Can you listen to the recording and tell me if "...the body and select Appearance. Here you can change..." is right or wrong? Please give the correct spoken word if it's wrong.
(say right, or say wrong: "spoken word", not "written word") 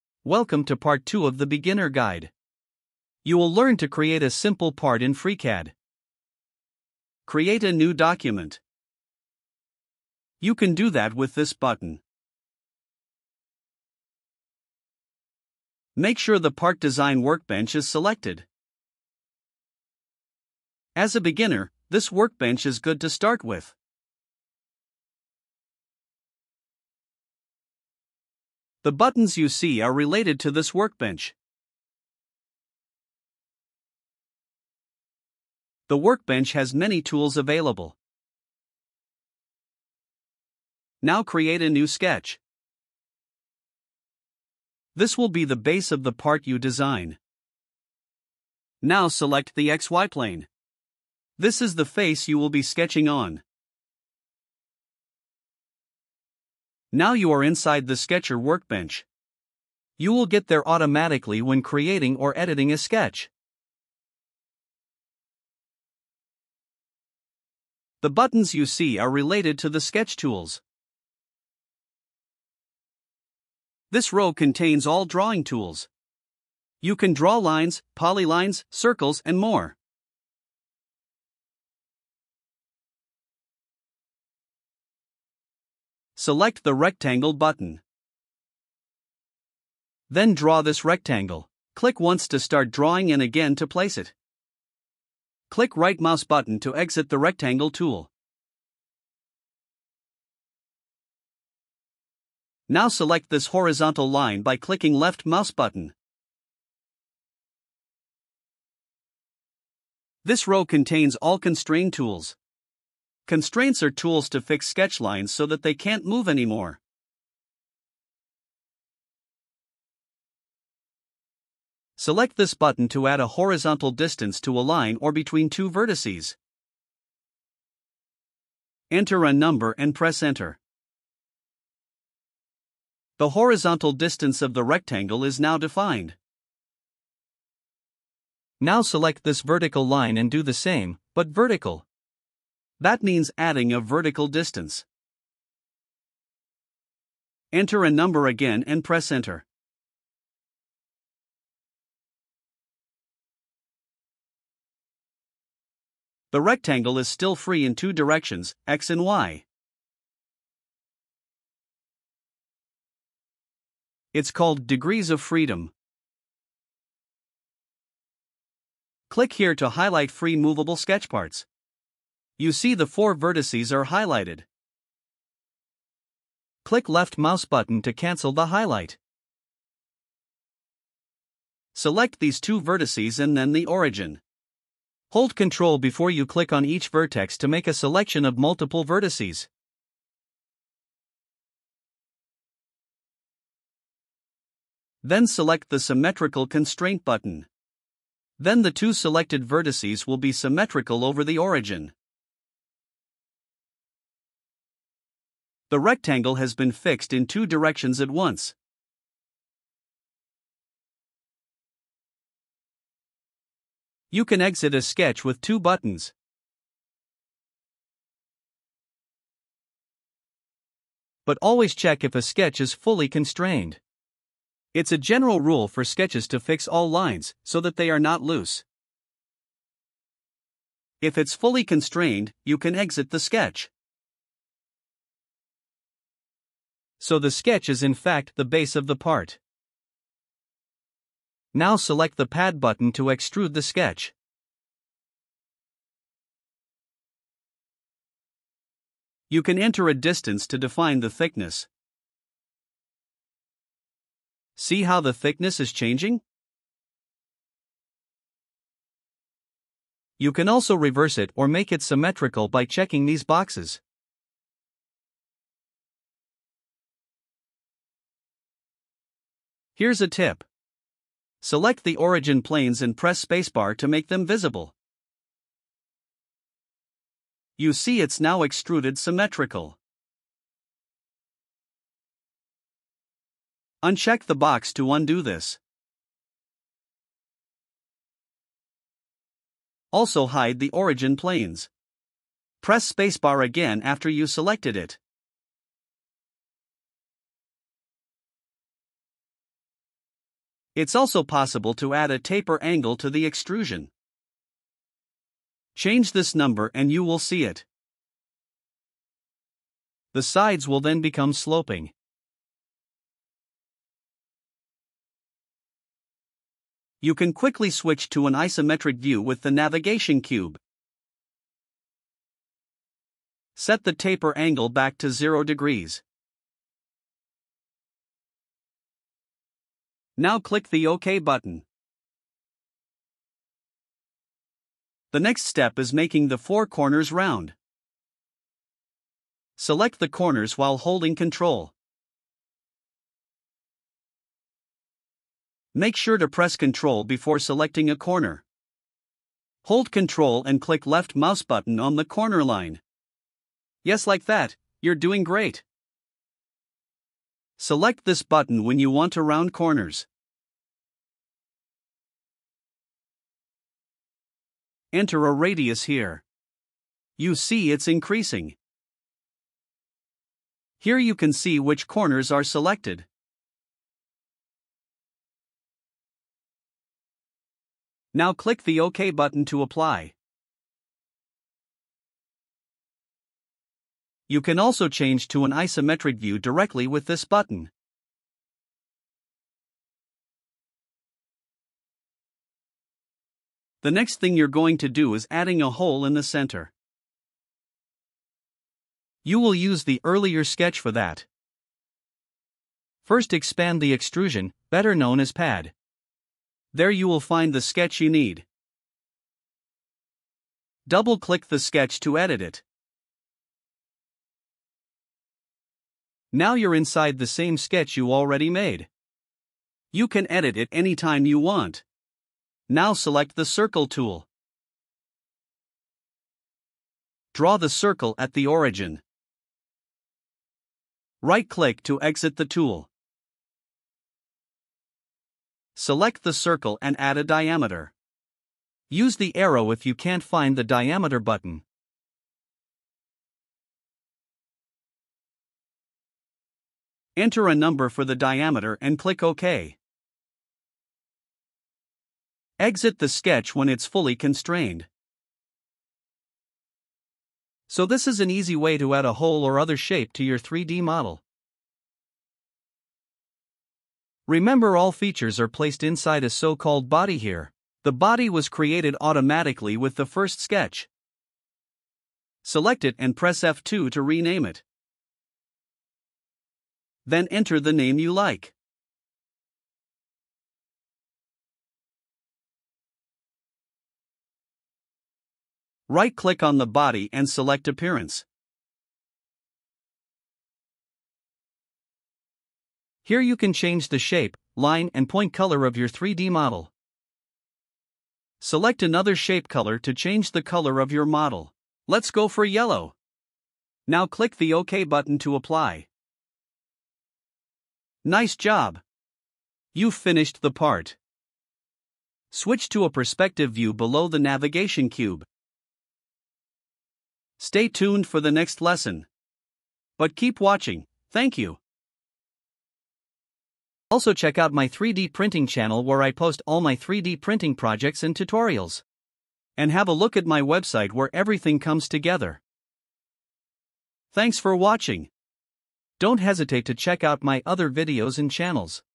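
right.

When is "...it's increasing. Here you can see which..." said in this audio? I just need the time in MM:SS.
06:07.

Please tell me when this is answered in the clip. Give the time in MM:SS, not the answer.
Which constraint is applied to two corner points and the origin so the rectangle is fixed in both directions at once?
03:15.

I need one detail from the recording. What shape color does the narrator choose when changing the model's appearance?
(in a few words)
Yellow.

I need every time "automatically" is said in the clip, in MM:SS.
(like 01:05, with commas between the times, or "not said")
01:00, 07:49.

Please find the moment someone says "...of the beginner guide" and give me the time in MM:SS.
00:01.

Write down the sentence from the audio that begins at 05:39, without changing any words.
Select the corners while holding Ctrl.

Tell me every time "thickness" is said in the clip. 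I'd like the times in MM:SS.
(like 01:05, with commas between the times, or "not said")
04:11, 04:15.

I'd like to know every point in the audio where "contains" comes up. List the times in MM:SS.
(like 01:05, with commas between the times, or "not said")
01:14, 01:50.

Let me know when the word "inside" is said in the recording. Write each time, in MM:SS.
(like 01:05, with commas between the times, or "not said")
00:57, 06:56, 07:45.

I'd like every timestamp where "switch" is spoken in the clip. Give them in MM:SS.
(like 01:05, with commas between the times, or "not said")
05:17, 08:32.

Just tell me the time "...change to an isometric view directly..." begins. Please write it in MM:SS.
06:24.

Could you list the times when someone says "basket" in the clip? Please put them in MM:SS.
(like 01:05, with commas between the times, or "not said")
not said.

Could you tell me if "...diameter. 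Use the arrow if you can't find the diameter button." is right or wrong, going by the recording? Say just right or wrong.
right.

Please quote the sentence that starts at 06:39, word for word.
You will use the earlier sketch for that.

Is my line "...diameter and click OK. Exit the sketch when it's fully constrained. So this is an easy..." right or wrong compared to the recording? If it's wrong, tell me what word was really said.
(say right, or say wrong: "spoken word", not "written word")
right.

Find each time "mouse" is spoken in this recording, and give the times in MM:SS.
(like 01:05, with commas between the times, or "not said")
01:35, 01:45, 02:57, 05:51.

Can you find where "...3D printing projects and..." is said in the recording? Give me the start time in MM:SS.
08:46.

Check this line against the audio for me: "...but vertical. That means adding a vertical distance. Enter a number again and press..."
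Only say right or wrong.
right.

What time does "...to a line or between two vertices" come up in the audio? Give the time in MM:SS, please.
02:04.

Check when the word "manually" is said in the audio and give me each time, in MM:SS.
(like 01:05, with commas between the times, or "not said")
not said.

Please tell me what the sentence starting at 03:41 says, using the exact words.
But always check if a sketch is fully constrained.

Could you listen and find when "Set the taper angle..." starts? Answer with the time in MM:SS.
05:23.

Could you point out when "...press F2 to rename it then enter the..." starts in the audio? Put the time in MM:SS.
07:53.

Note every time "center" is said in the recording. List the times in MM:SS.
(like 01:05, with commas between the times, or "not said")
06:36.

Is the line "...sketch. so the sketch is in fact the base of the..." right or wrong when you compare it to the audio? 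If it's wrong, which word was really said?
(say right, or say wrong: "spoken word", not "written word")
right.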